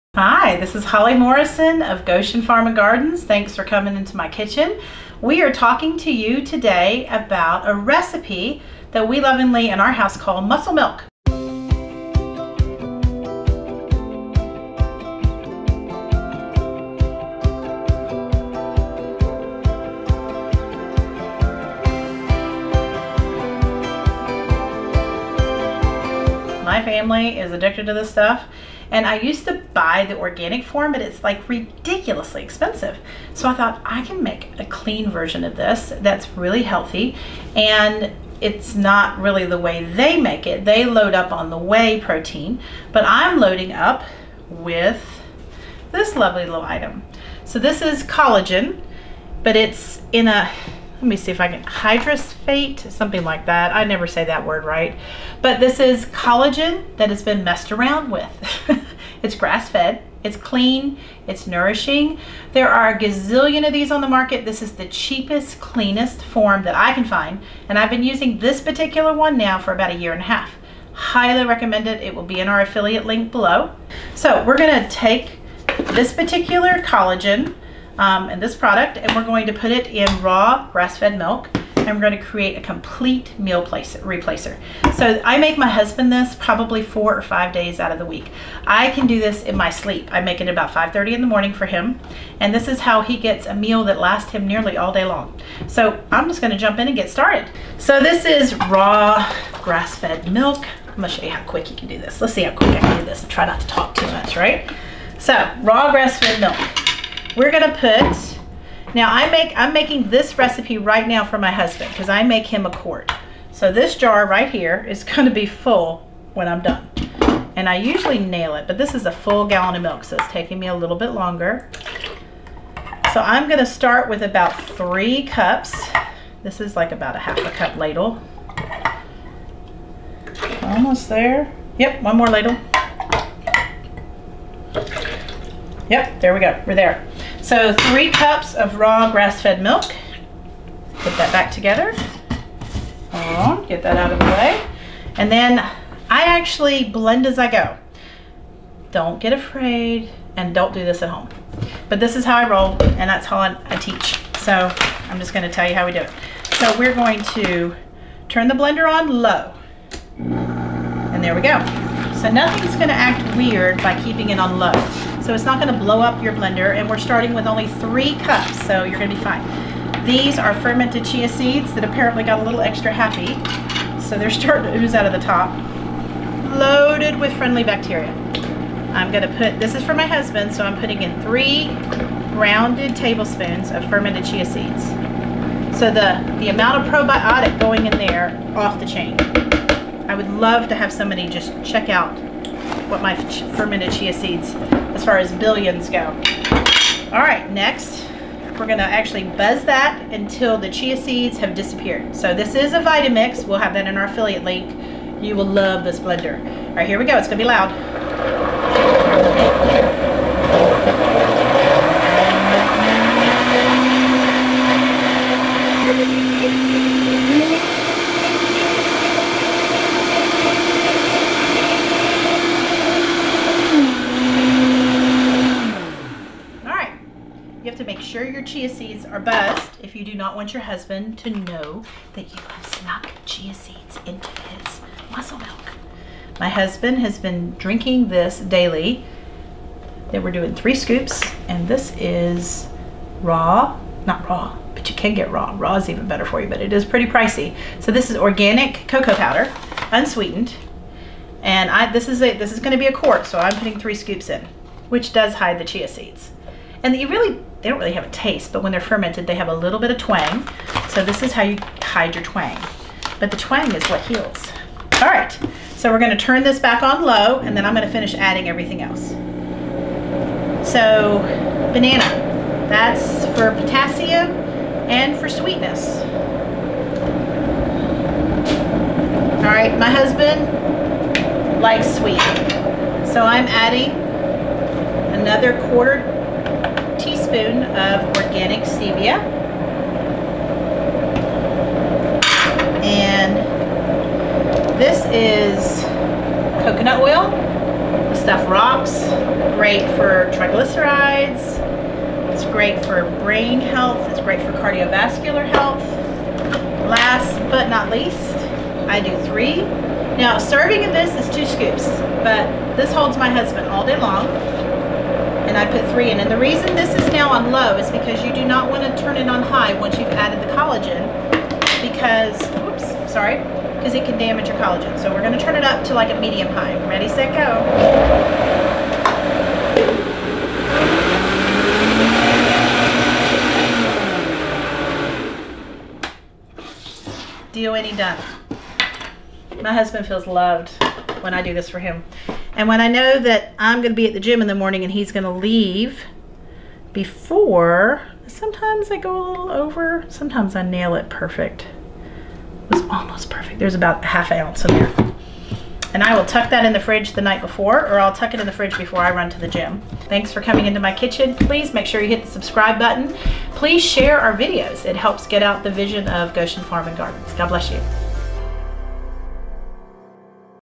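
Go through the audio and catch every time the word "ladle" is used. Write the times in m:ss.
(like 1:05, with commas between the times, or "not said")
2:07, 2:12.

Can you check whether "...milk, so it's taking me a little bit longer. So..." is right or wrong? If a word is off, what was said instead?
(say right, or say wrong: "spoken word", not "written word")
right.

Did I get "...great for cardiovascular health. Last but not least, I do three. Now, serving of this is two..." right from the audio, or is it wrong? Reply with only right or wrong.
right.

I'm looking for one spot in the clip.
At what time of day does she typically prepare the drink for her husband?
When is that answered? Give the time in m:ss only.
1:30.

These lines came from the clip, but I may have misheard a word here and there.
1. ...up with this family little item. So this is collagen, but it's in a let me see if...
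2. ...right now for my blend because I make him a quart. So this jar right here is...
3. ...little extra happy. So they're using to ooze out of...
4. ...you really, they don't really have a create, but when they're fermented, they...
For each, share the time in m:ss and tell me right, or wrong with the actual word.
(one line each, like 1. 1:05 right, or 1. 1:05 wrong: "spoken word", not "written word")
1. 0:43 wrong: "lovely", not "family"
2. 1:50 wrong: "husband", not "blend"
3. 2:52 wrong: "starting", not "using"
4. 4:16 wrong: "taste", not "create".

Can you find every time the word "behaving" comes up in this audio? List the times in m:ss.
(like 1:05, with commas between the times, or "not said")
not said.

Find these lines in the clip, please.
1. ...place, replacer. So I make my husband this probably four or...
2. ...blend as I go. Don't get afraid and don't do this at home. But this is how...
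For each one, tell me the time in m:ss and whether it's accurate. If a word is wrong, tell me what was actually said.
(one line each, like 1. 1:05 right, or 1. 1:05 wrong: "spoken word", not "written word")
1. 1:23 right
2. 2:26 right.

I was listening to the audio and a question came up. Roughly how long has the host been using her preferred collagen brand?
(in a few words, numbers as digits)
a year and a half.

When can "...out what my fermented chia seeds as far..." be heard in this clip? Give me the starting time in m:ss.
3:11.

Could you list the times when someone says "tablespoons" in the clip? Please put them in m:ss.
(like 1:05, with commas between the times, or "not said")
3:02, 4:47.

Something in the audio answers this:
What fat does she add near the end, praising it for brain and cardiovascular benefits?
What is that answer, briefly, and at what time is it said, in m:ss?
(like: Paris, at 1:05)
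coconut oil, at 4:56.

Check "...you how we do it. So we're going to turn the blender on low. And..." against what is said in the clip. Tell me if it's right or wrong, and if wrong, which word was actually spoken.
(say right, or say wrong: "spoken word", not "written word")
right.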